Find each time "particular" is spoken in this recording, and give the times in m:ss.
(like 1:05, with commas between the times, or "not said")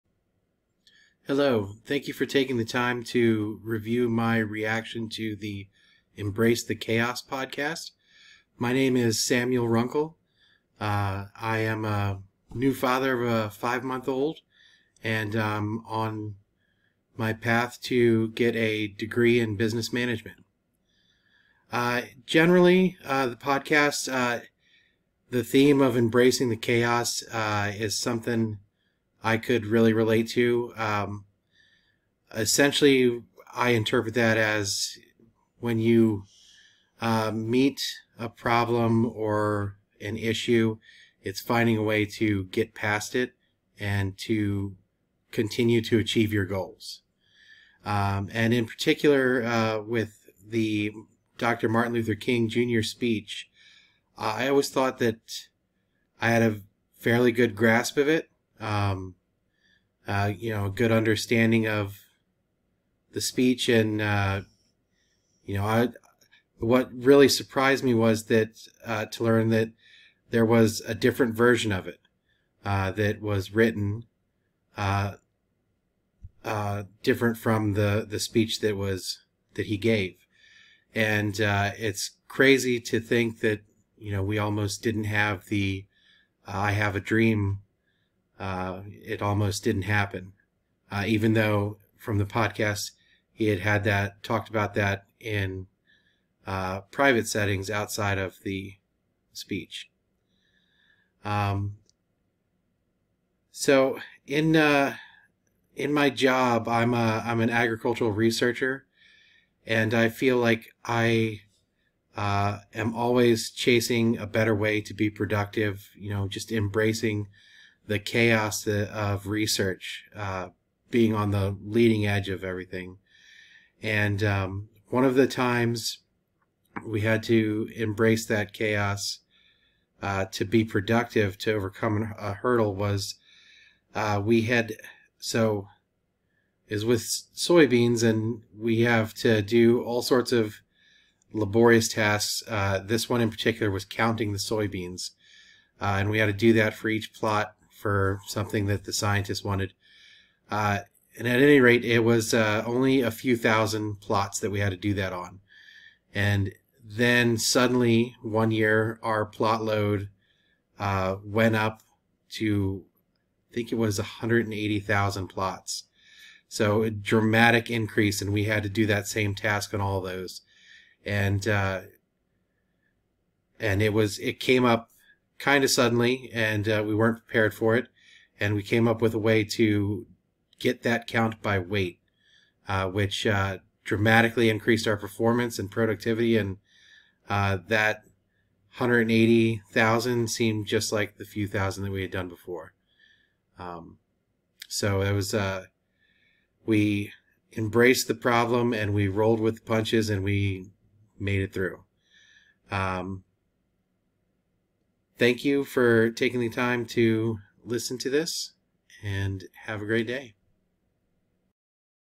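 0:48, 2:23.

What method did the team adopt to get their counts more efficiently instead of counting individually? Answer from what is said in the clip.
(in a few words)
by weight.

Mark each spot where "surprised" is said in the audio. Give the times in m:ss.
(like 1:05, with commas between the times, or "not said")
1:07.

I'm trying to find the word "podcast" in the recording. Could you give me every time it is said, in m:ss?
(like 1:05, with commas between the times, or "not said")
0:07, 0:23, 1:32.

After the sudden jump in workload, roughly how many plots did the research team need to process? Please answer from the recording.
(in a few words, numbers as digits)
180,000.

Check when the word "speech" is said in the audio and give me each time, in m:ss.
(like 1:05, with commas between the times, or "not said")
0:52, 1:03, 1:18, 1:39.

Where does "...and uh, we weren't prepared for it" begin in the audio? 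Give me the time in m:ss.
2:56.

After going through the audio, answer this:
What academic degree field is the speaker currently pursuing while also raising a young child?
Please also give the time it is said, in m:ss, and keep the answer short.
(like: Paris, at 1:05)
business management, at 0:19.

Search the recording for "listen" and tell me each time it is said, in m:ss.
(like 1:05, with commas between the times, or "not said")
3:27.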